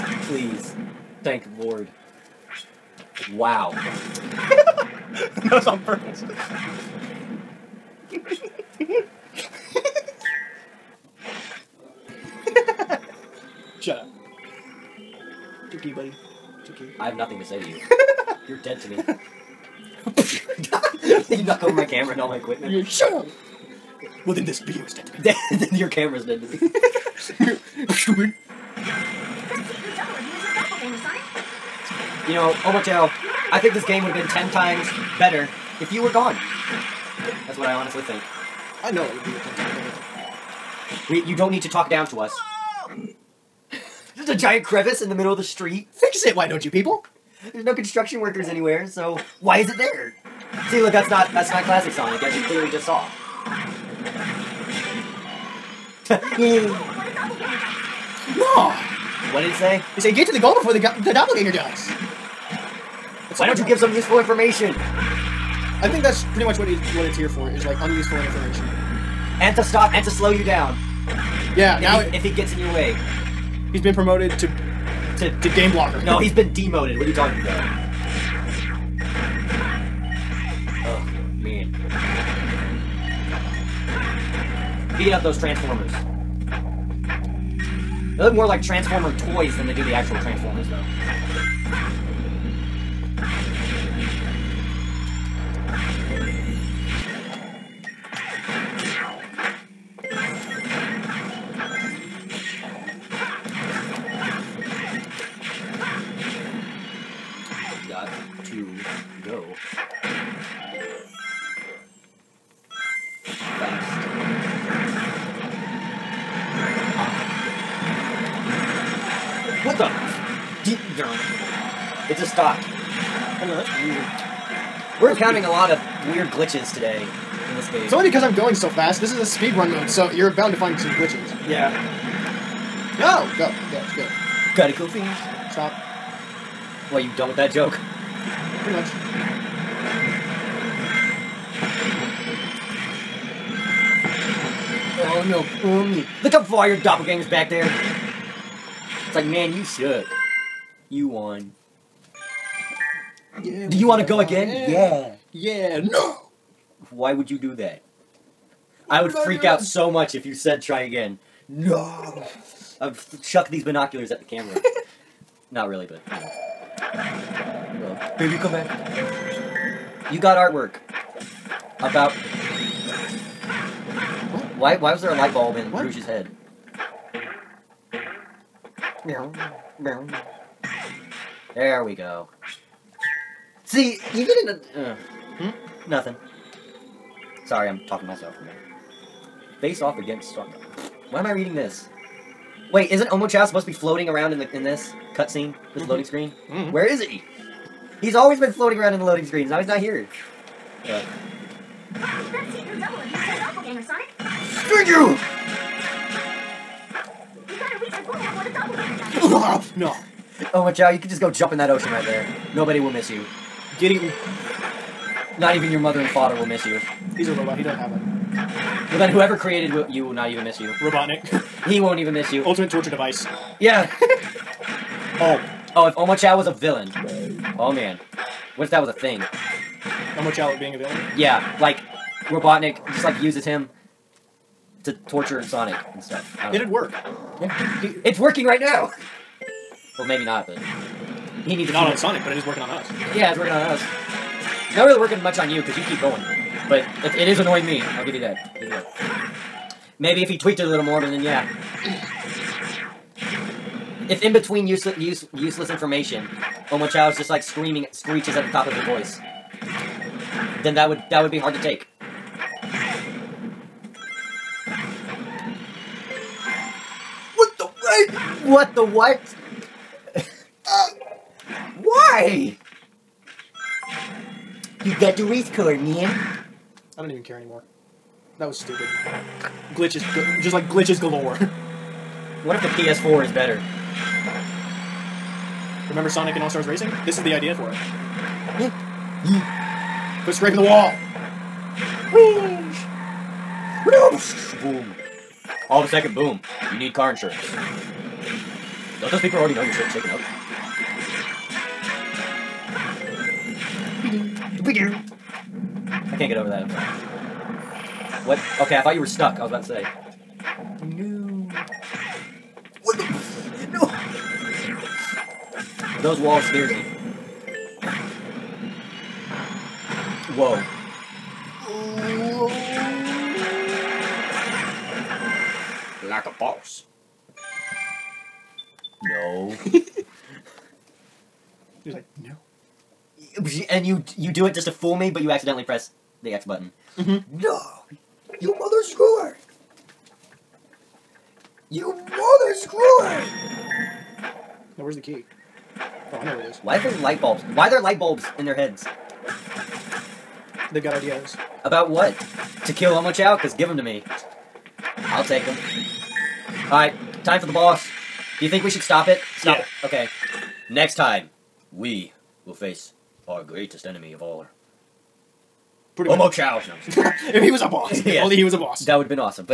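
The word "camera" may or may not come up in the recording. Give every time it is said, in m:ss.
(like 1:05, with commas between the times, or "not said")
0:21, 0:25, 2:44.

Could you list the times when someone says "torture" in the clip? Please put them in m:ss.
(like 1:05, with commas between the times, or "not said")
3:42, 3:55.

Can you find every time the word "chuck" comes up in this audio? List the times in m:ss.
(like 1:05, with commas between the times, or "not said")
2:43.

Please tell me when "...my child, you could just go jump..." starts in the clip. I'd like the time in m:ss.
3:30.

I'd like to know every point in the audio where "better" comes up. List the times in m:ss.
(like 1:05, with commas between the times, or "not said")
0:35, 0:41, 4:43.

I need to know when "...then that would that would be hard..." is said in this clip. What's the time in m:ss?
4:20.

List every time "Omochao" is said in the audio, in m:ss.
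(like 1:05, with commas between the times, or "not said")
0:32, 3:13, 3:45, 3:50, 4:16, 5:52, 6:06.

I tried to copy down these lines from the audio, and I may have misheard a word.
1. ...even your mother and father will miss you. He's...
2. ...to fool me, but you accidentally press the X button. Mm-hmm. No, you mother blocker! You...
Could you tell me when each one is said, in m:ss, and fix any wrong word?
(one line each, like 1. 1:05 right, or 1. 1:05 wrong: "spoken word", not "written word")
1. 3:35 right
2. 5:34 wrong: "screwer", not "blocker".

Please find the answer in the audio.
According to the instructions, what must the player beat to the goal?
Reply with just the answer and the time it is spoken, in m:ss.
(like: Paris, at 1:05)
The doppelganger, at 1:00.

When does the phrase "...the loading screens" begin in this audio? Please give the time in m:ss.
3:18.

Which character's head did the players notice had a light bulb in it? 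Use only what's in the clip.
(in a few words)
Rouge.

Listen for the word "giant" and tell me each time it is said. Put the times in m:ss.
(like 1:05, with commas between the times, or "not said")
0:44.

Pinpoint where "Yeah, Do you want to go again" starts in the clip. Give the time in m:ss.
2:33.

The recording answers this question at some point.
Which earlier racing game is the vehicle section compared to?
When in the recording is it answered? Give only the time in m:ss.
4:46.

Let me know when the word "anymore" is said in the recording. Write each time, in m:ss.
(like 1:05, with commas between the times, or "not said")
4:37.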